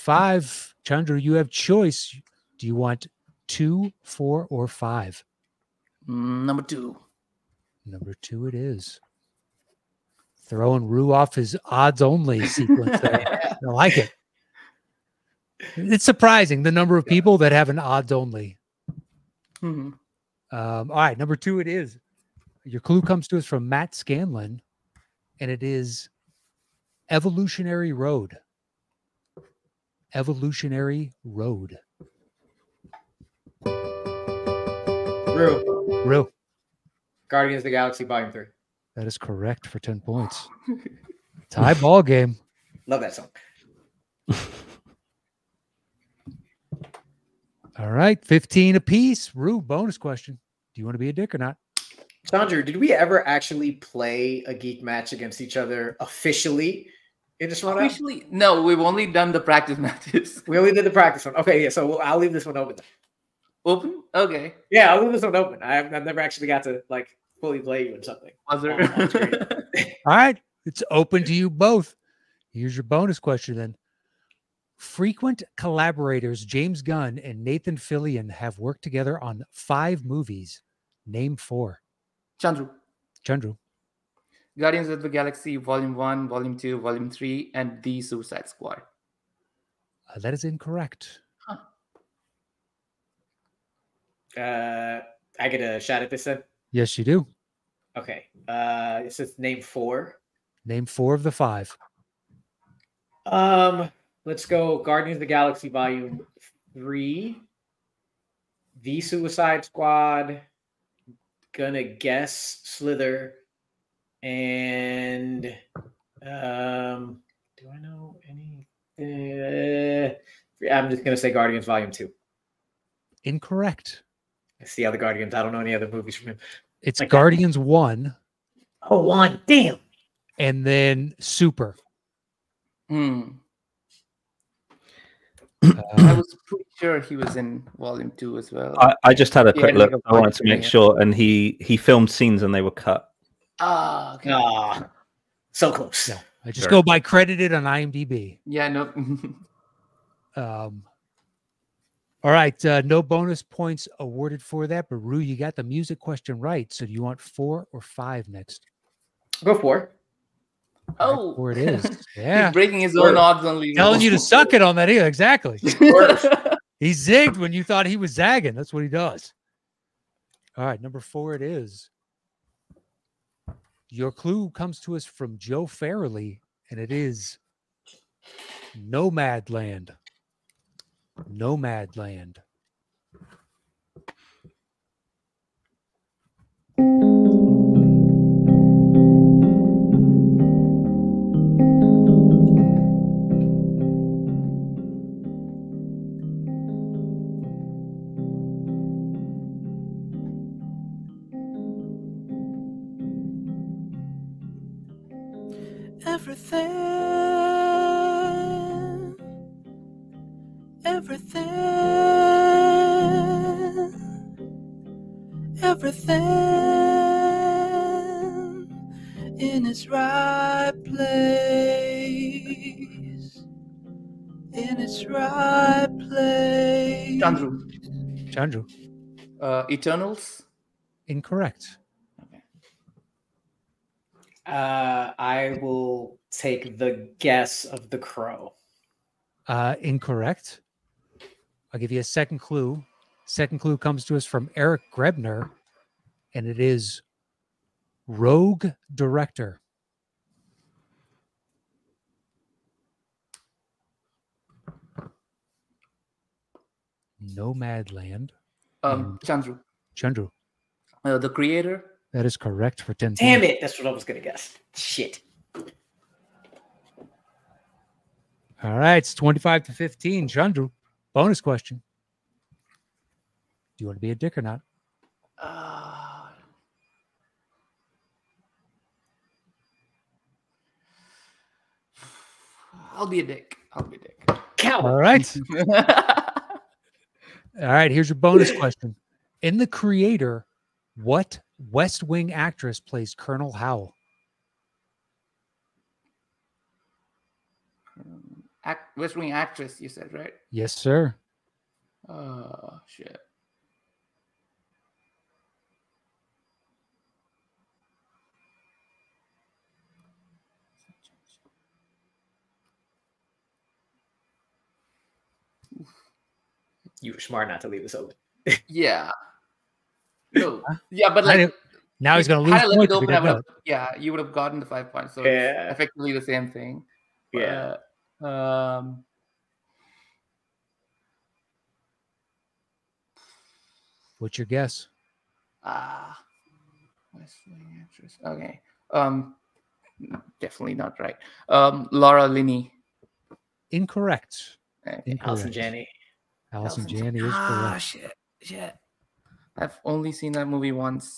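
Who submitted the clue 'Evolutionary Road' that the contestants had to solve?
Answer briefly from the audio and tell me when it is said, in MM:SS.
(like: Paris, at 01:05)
Matt Scanlon, at 00:23.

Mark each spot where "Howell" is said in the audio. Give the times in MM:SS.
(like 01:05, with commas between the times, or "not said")
04:53.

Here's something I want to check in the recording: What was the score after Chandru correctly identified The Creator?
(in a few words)
25 to 15.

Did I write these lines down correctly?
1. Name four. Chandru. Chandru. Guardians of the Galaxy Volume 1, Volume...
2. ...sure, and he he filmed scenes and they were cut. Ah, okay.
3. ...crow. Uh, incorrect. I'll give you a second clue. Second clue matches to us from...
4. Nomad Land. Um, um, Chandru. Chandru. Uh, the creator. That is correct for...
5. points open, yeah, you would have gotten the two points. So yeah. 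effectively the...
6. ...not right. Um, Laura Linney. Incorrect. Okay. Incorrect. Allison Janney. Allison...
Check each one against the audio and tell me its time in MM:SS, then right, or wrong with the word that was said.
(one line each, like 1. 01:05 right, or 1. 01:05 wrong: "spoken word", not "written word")
1. 01:21 right
2. 02:20 right
3. 03:57 wrong: "comes", not "matches"
4. 04:17 right
5. 05:22 wrong: "five", not "two"
6. 05:40 right.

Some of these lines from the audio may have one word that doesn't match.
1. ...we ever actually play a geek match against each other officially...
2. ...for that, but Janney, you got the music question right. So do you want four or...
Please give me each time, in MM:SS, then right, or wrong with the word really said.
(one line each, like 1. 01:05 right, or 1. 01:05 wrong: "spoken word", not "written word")
1. 00:52 right
2. 02:34 wrong: "Rue", not "Janney".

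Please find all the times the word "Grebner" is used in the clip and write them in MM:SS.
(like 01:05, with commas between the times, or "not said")
04:04.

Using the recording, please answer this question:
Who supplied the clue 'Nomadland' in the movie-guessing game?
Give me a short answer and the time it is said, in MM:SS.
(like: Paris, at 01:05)
Joe Farrelly, at 02:55.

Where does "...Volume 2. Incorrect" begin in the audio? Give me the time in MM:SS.
02:01.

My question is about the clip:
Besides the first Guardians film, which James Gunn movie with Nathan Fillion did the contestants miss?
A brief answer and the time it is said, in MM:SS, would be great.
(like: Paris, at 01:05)
Super, at 02:11.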